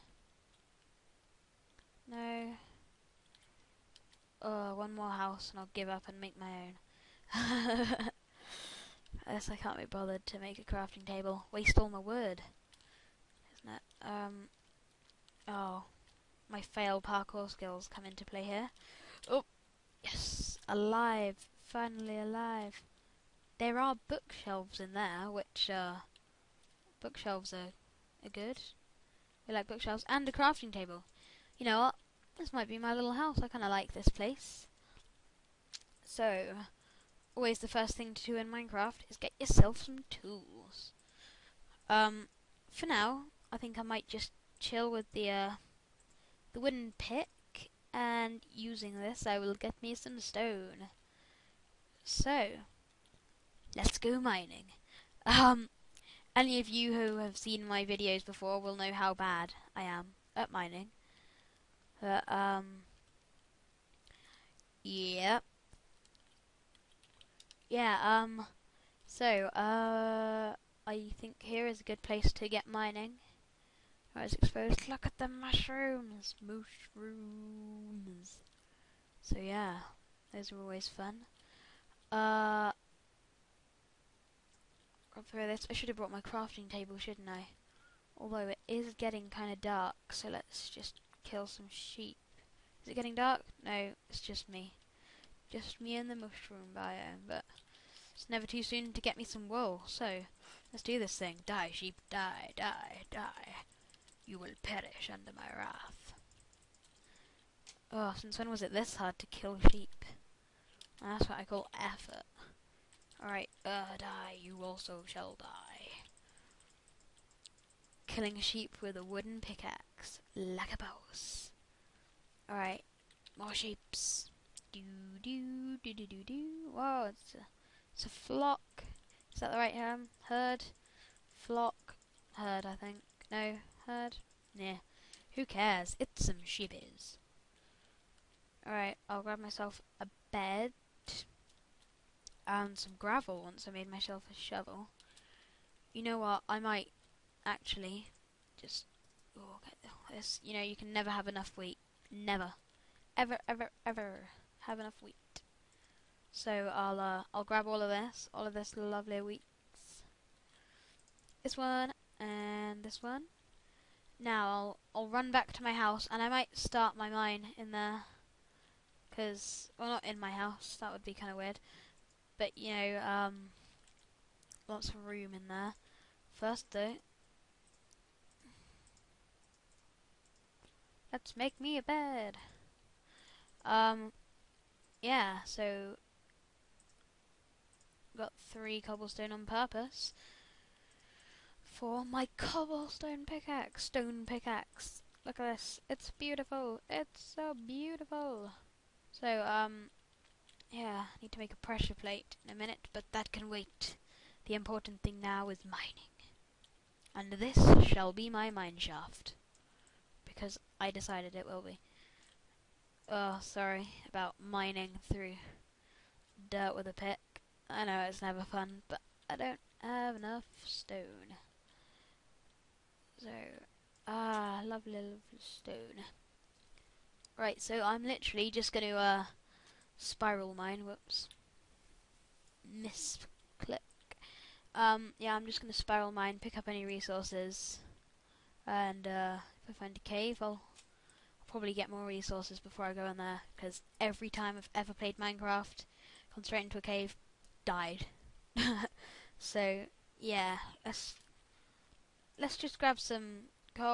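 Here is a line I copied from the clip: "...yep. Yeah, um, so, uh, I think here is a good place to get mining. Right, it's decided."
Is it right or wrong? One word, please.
wrong.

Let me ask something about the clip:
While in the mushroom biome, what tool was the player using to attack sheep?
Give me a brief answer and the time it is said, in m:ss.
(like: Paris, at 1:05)
Wooden pickaxe, at 1:59.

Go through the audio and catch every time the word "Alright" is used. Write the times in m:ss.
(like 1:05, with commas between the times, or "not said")
1:53, 2:02.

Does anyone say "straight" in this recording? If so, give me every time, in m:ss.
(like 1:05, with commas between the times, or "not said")
4:06.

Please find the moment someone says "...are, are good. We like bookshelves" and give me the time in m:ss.
0:27.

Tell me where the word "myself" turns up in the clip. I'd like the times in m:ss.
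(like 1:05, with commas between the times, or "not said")
2:19, 2:23.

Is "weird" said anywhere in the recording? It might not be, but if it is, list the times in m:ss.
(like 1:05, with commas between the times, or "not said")
2:51.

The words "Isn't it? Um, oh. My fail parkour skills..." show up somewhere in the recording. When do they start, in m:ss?
0:13.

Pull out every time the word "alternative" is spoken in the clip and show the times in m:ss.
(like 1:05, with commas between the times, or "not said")
not said.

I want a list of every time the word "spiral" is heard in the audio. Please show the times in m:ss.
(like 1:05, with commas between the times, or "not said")
3:49, 3:55.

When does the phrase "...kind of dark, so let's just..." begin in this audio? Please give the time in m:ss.
1:29.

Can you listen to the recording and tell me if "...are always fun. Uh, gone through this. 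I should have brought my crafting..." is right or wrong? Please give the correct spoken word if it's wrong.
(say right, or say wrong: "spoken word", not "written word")
right.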